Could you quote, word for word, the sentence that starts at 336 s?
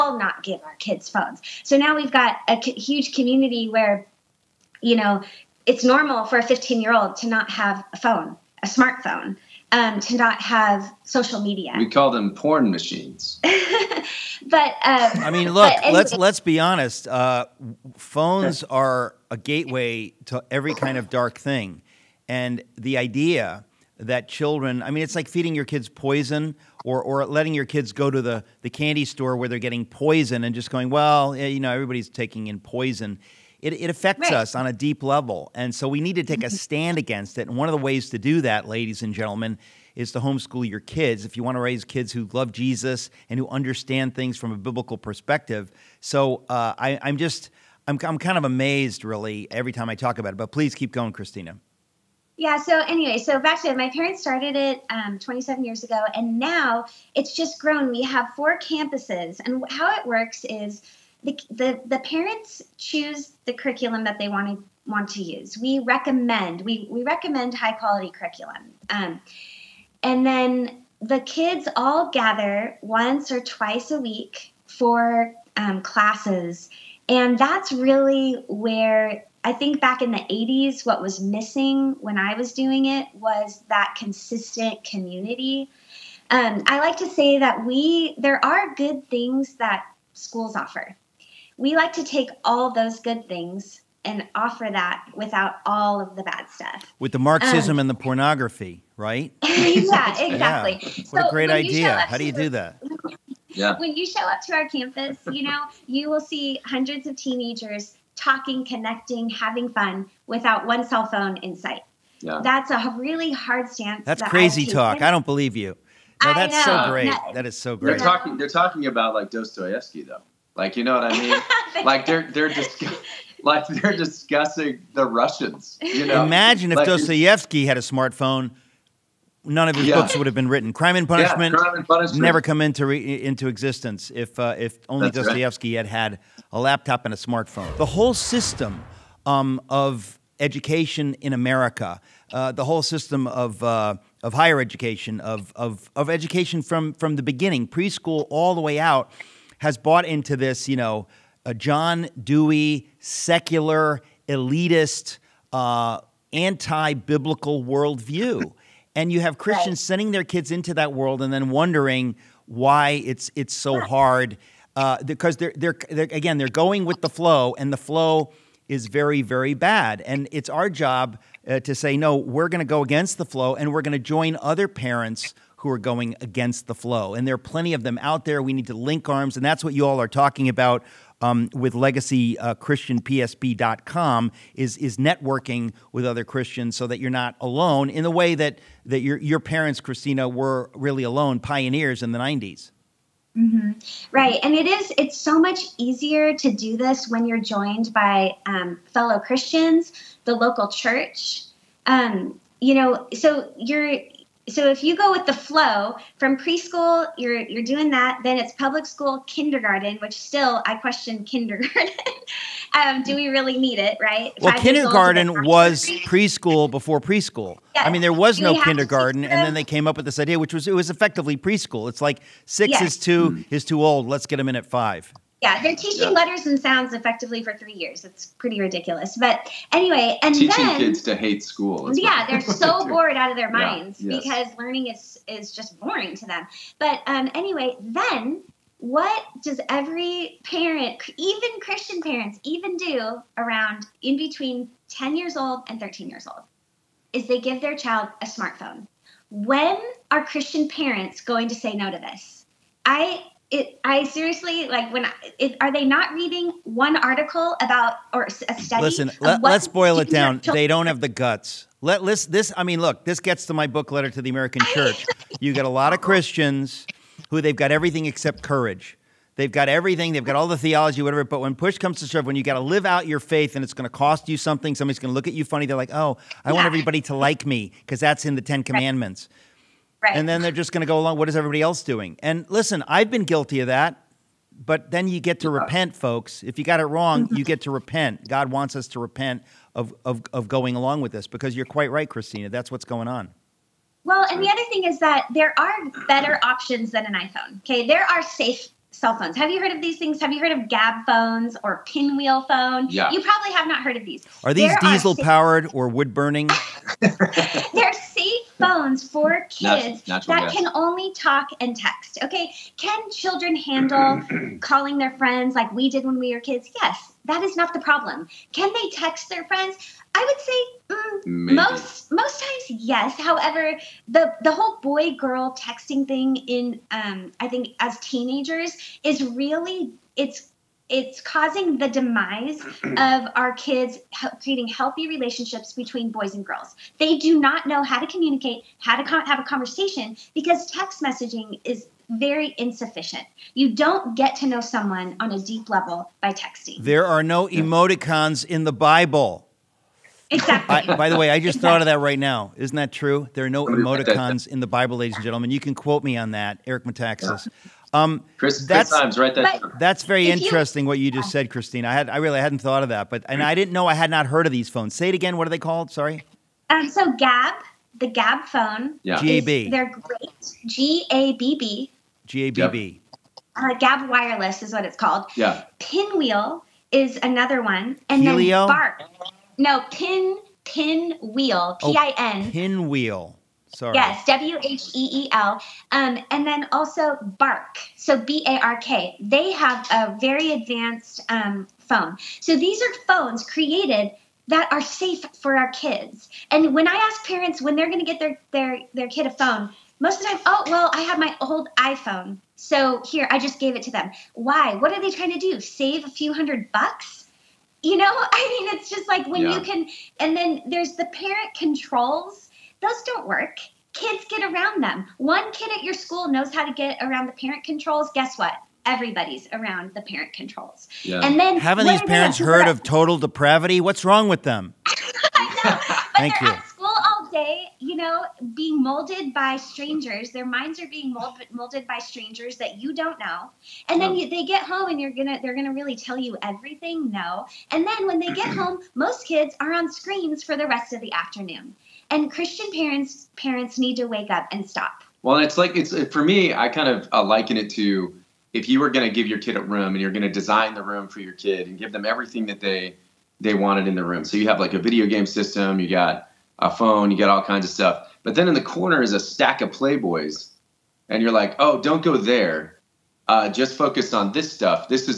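They do not know how to communicate, how to have a conversation because text messaging is very insufficient.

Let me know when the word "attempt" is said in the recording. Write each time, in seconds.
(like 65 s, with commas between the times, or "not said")
not said.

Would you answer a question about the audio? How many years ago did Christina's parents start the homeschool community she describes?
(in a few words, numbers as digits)
27.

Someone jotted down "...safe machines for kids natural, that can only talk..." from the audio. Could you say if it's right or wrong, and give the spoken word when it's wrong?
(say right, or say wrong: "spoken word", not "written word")
wrong: "phones", not "machines".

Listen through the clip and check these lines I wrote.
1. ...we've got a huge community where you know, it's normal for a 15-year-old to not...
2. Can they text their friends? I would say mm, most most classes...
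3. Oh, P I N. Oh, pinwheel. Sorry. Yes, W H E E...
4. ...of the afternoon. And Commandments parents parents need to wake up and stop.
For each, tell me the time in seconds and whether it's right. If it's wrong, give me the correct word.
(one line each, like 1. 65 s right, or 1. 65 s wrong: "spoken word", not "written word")
1. 1 s right
2. 318 s wrong: "times", not "classes"
3. 381 s right
4. 440 s wrong: "Christian", not "Commandments".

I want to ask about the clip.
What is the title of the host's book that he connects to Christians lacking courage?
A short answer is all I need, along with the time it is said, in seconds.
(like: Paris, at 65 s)
Letter to the American Church, at 263 s.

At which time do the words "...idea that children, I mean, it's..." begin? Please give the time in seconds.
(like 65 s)
22 s.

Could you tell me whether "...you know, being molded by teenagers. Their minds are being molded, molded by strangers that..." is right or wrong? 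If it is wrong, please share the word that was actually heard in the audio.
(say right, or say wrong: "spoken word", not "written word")
wrong: "strangers", not "teenagers".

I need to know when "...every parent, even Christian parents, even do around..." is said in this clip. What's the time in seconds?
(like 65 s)
239 s.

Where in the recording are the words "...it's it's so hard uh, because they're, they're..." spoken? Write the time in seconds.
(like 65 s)
163 s.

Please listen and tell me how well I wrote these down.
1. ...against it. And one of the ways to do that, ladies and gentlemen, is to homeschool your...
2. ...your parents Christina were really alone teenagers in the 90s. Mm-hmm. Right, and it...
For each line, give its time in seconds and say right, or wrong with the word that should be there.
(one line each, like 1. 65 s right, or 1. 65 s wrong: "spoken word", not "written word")
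1. 36 s right
2. 189 s wrong: "pioneers", not "teenagers".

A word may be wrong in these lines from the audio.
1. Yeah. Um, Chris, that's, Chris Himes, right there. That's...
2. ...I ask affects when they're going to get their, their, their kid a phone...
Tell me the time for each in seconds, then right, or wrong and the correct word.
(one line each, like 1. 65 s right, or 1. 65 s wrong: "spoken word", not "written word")
1. 357 s right
2. 396 s wrong: "parents", not "affects".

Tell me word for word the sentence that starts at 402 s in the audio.
So here, I just gave it to them.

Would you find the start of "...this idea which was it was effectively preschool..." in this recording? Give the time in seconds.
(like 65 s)
220 s.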